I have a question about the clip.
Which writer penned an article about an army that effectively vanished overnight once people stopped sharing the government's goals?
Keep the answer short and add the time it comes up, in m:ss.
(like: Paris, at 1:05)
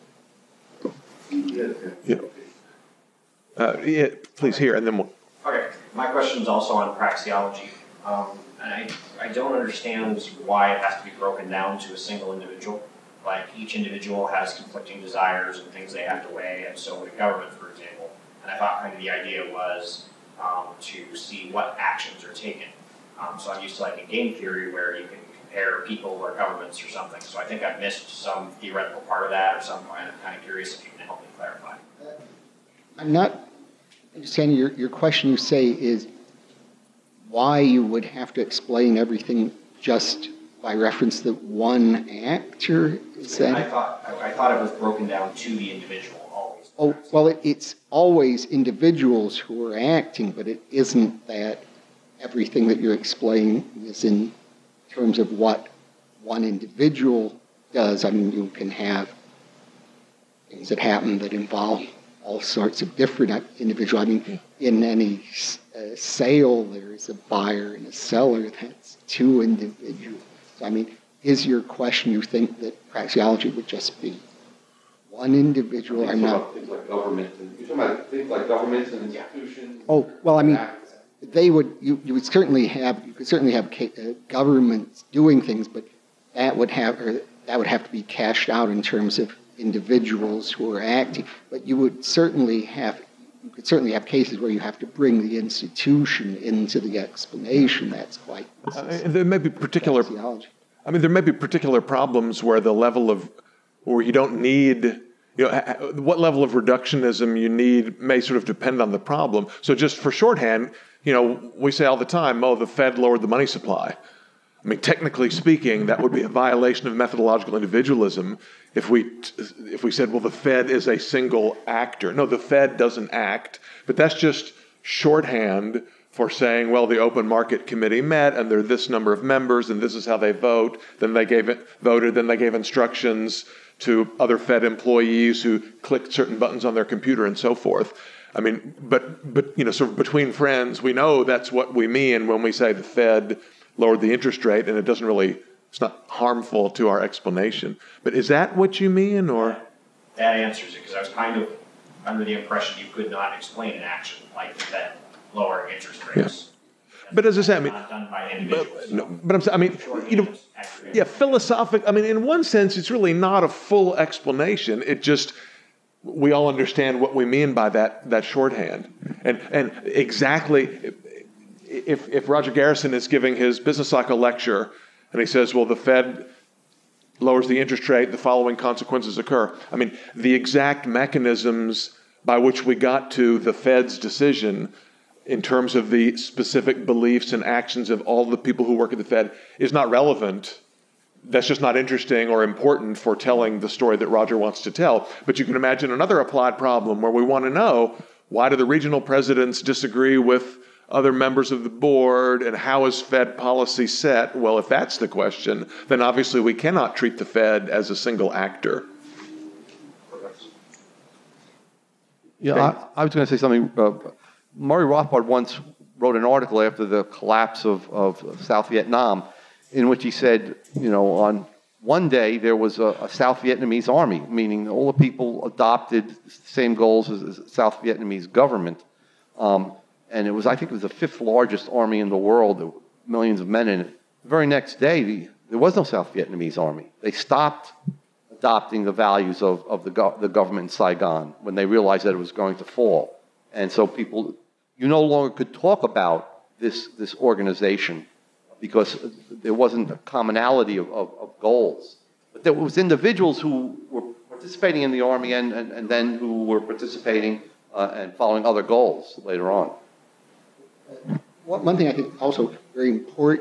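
Murray Rothbard, at 3:34.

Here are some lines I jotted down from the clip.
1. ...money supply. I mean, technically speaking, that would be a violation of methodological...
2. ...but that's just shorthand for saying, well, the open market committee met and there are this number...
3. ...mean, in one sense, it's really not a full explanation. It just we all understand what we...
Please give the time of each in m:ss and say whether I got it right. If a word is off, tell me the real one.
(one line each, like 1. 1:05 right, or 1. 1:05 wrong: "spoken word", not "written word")
1. 1:53 right
2. 2:03 right
3. 2:41 right.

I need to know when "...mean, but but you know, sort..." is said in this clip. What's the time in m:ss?
2:18.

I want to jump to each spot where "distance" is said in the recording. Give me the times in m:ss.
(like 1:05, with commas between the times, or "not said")
not said.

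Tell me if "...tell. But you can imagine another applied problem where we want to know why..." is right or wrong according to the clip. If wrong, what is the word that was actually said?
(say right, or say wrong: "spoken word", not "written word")
right.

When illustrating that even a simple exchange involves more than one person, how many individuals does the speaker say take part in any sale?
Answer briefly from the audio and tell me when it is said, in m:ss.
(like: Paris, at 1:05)
2, at 1:08.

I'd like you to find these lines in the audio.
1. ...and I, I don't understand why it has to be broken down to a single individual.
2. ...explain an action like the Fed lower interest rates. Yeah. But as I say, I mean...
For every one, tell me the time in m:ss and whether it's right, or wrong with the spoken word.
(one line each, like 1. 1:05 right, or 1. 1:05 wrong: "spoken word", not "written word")
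1. 0:08 right
2. 2:33 right.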